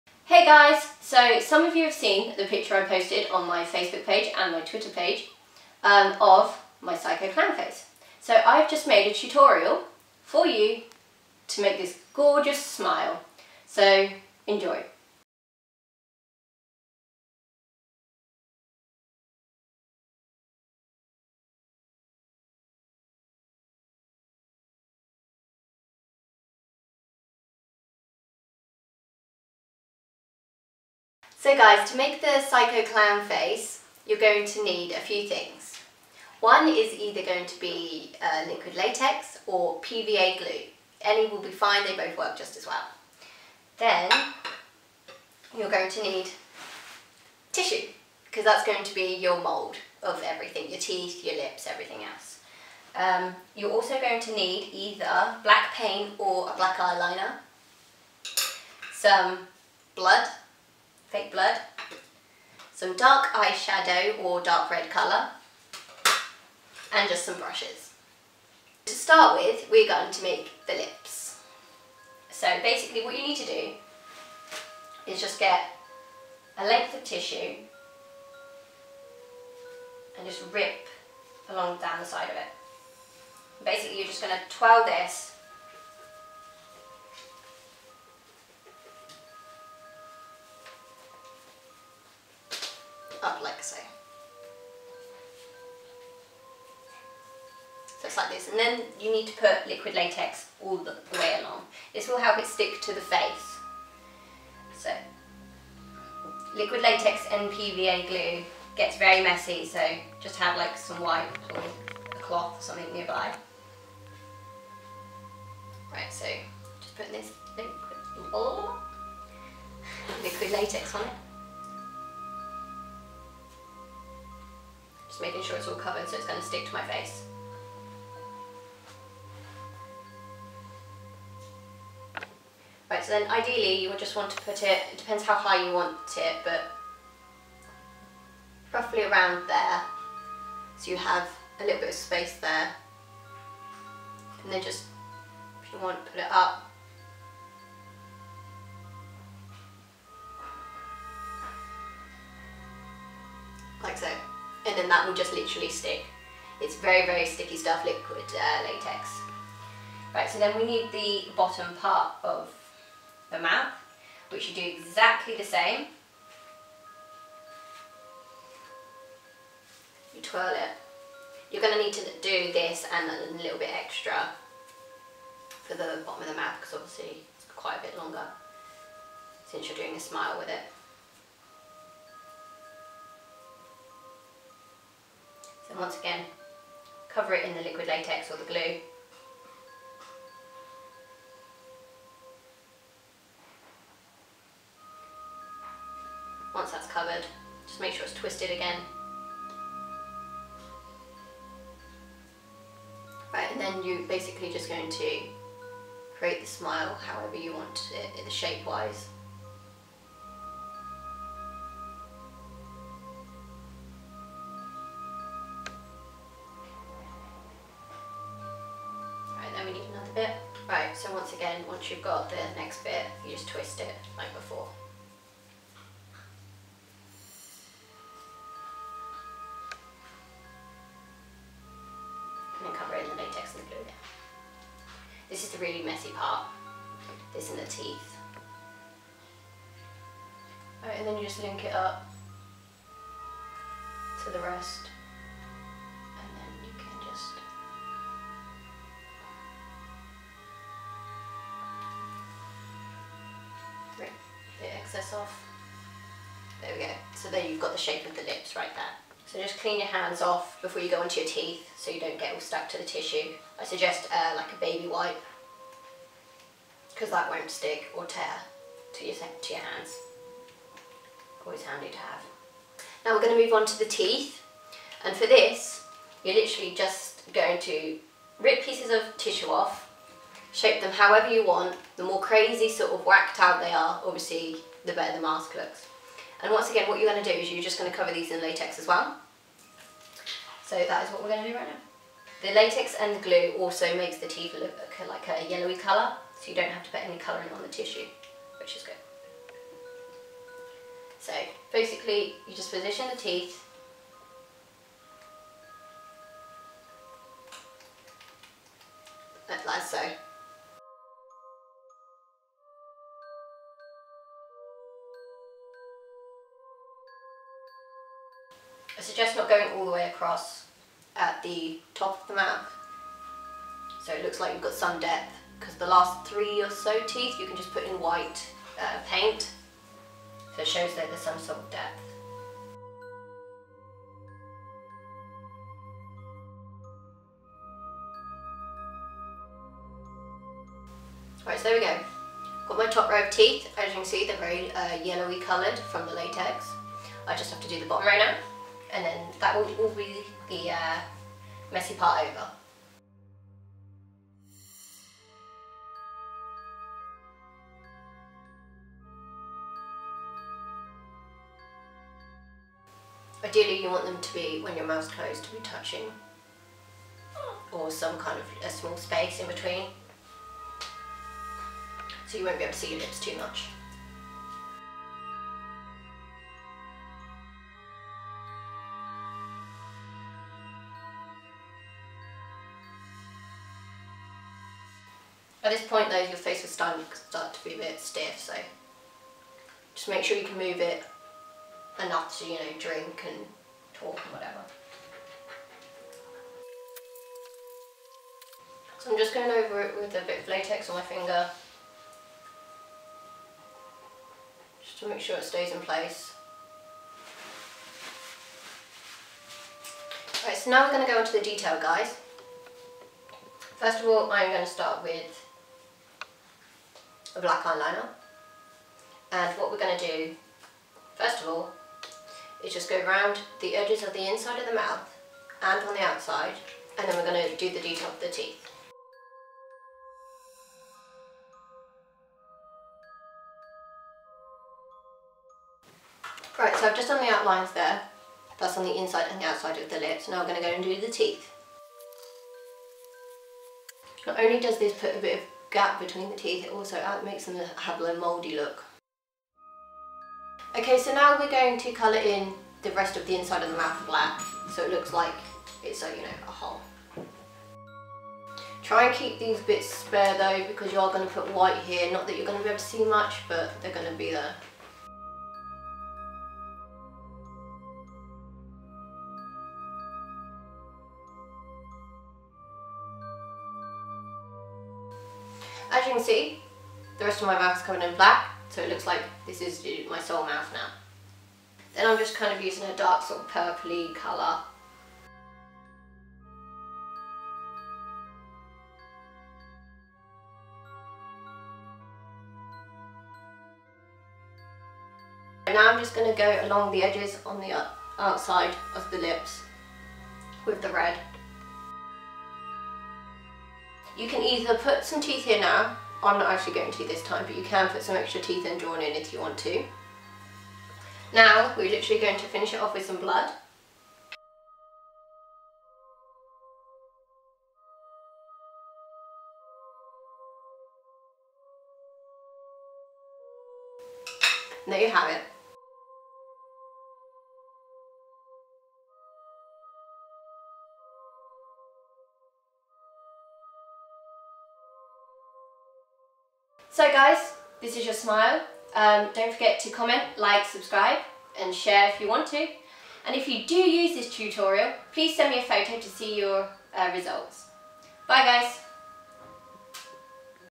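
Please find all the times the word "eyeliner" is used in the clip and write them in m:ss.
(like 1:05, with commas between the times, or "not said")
0:56, 6:57.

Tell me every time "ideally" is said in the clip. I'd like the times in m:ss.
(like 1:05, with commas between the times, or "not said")
2:13, 6:03.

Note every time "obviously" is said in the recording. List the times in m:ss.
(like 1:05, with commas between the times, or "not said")
2:56, 4:44.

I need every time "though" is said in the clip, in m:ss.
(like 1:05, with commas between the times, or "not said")
6:26, 7:40.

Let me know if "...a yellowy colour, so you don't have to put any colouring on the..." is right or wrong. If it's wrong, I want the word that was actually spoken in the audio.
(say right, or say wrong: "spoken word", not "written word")
right.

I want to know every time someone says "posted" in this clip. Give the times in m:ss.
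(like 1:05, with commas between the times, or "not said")
0:02.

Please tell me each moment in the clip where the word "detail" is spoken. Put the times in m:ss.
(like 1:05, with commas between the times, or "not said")
6:51, 7:07.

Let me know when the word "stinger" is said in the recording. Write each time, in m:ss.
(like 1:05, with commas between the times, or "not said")
not said.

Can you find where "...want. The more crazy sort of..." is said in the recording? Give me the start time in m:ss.
4:41.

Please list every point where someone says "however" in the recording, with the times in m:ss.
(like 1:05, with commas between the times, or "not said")
3:26, 4:40.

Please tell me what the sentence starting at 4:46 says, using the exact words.
And once again, what you're going to do is you're just going to cover these in latex as well.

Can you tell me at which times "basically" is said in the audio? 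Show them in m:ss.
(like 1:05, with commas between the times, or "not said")
1:12, 1:23, 3:24, 5:01.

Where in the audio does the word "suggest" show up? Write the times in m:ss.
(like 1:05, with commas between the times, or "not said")
4:23, 5:19.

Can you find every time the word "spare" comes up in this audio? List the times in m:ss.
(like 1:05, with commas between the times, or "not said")
7:39.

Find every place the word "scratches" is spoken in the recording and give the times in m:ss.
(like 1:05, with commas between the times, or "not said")
not said.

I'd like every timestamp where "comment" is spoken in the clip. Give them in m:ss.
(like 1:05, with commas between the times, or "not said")
8:59.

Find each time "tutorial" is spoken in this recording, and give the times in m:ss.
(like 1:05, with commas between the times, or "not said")
0:09, 9:04.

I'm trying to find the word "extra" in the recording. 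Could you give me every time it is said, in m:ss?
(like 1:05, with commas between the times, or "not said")
2:53, 8:28.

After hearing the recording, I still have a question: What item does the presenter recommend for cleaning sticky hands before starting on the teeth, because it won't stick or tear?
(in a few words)
A baby wipe.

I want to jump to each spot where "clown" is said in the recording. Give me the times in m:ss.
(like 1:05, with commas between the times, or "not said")
0:07, 0:32.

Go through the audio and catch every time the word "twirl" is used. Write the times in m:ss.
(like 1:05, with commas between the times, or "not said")
1:24, 2:50.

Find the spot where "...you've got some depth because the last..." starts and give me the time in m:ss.
5:24.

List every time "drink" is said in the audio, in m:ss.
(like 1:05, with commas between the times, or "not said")
6:32.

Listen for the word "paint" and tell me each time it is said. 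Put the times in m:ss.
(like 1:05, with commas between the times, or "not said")
0:55, 5:29.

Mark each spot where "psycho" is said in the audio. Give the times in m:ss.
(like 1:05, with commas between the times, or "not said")
0:06, 0:32.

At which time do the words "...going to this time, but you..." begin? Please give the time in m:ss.
8:26.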